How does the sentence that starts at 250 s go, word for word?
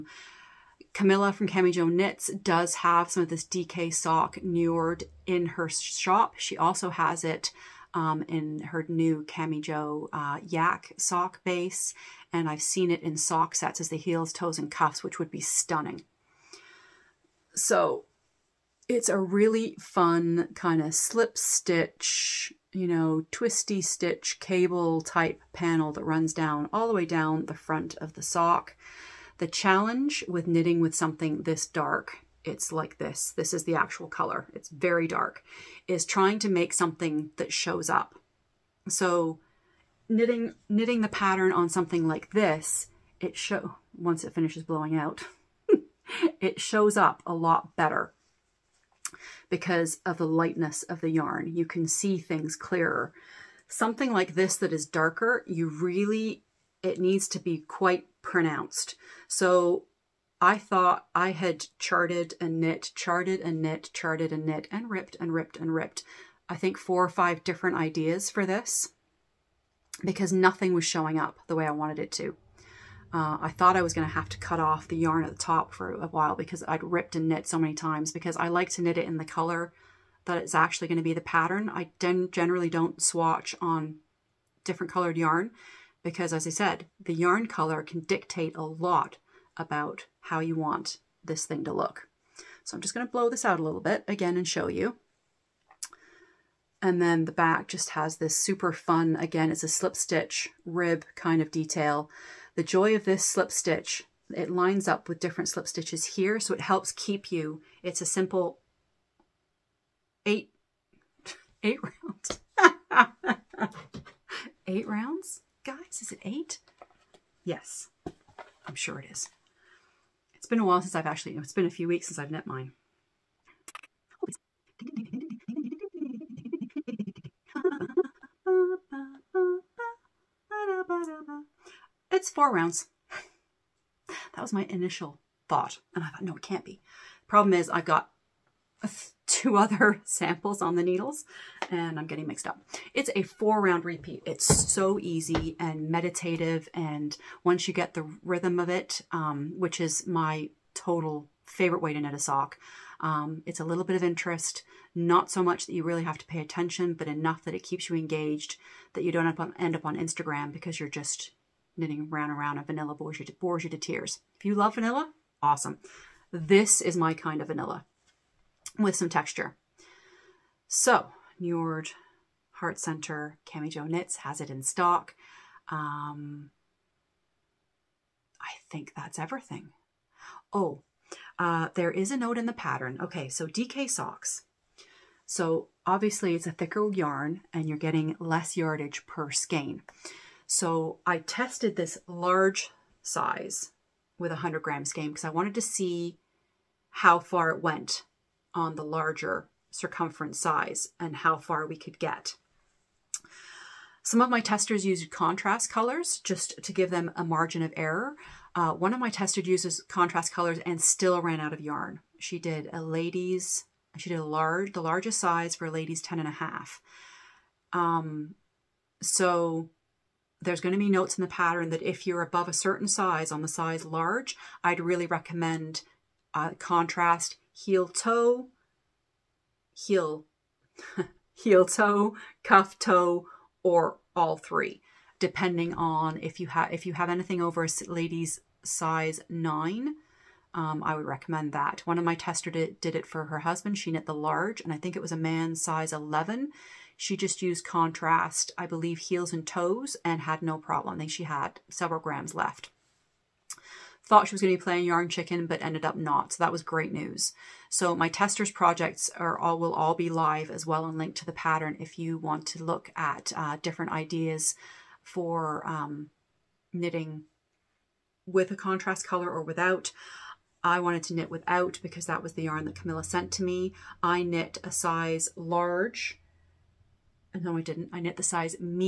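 I think she had several grams left.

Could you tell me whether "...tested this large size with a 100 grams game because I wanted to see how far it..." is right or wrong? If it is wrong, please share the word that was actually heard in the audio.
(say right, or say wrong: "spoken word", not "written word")
right.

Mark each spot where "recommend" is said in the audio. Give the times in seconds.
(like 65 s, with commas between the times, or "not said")
225 s, 241 s.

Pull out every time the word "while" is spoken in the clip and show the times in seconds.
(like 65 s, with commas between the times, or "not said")
76 s, 120 s.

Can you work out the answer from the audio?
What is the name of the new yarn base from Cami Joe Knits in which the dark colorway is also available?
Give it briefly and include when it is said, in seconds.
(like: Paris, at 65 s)
Yak sock base, at 10 s.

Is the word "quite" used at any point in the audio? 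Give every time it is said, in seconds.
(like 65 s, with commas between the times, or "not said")
57 s.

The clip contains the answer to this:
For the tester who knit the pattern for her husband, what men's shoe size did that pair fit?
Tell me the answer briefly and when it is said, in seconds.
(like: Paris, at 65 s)
11, at 245 s.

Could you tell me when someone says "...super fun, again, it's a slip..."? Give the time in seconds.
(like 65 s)
98 s.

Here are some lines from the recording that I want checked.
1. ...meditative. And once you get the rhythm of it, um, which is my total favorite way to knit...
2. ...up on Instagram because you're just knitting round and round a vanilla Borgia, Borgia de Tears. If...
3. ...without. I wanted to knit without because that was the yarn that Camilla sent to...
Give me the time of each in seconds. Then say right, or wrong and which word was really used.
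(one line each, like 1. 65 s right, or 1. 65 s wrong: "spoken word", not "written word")
1. 145 s right
2. 159 s right
3. 269 s right.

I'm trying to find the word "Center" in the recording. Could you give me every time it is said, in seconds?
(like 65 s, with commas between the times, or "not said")
172 s.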